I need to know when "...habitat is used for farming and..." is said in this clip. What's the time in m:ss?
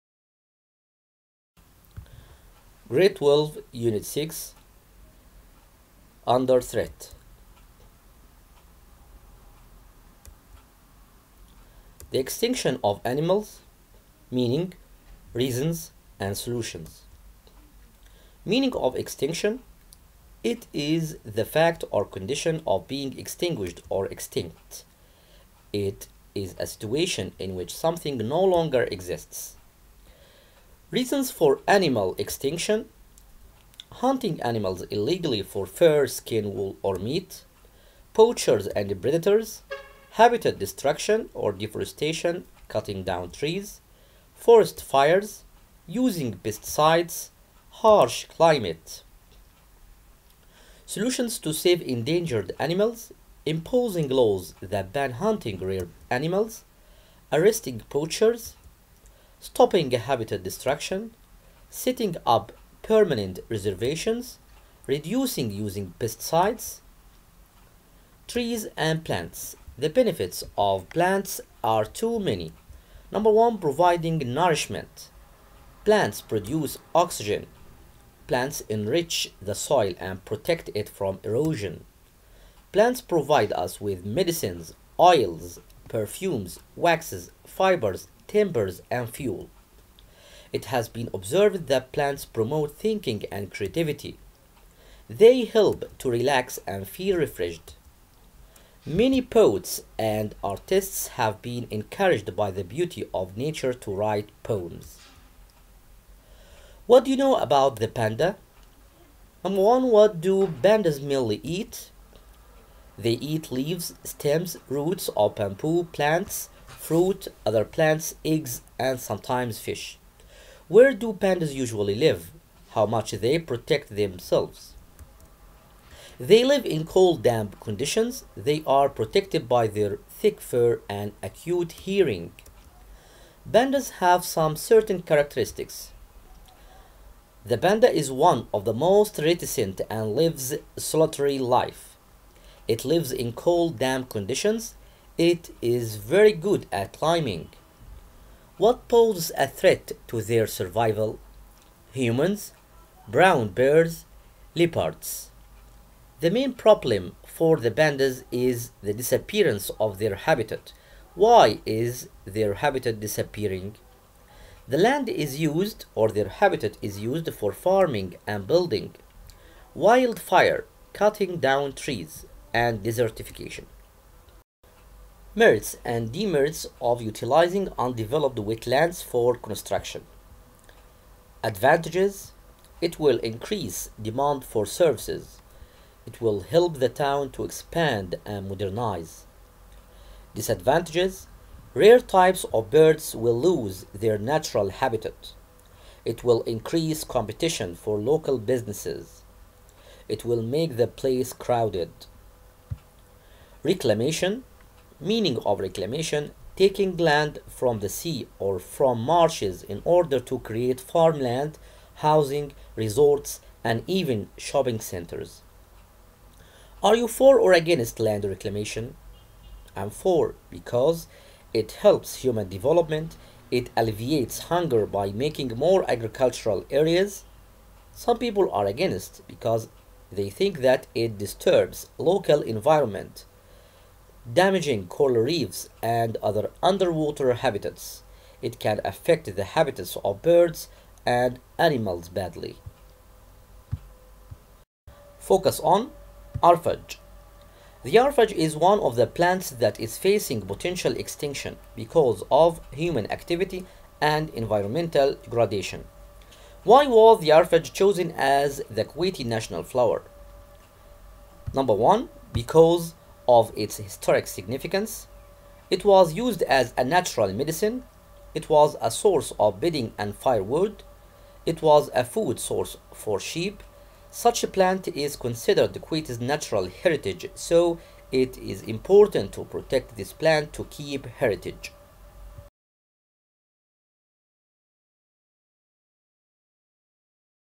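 2:46.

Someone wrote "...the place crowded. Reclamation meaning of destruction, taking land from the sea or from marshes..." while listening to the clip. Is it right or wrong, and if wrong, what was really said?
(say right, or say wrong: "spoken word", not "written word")
wrong: "reclamation", not "destruction".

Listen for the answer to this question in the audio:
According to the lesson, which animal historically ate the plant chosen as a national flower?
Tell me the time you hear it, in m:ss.
4:33.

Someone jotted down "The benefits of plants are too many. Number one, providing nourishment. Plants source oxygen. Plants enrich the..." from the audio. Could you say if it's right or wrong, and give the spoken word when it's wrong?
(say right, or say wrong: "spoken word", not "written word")
wrong: "produce", not "source".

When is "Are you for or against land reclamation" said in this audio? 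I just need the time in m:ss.
3:36.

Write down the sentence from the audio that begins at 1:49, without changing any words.
Number one, what do pandas mainly eat?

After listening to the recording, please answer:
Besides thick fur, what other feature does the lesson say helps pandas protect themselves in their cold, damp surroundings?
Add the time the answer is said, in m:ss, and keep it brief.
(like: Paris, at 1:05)
Acute hearing, at 2:11.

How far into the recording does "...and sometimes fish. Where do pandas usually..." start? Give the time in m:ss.
1:58.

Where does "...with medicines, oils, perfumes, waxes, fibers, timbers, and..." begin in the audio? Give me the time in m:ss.
1:23.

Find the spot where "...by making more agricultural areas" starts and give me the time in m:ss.
3:44.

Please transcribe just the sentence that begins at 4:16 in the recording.
Why was the arfaj chosen as the Kuwaiti national flower?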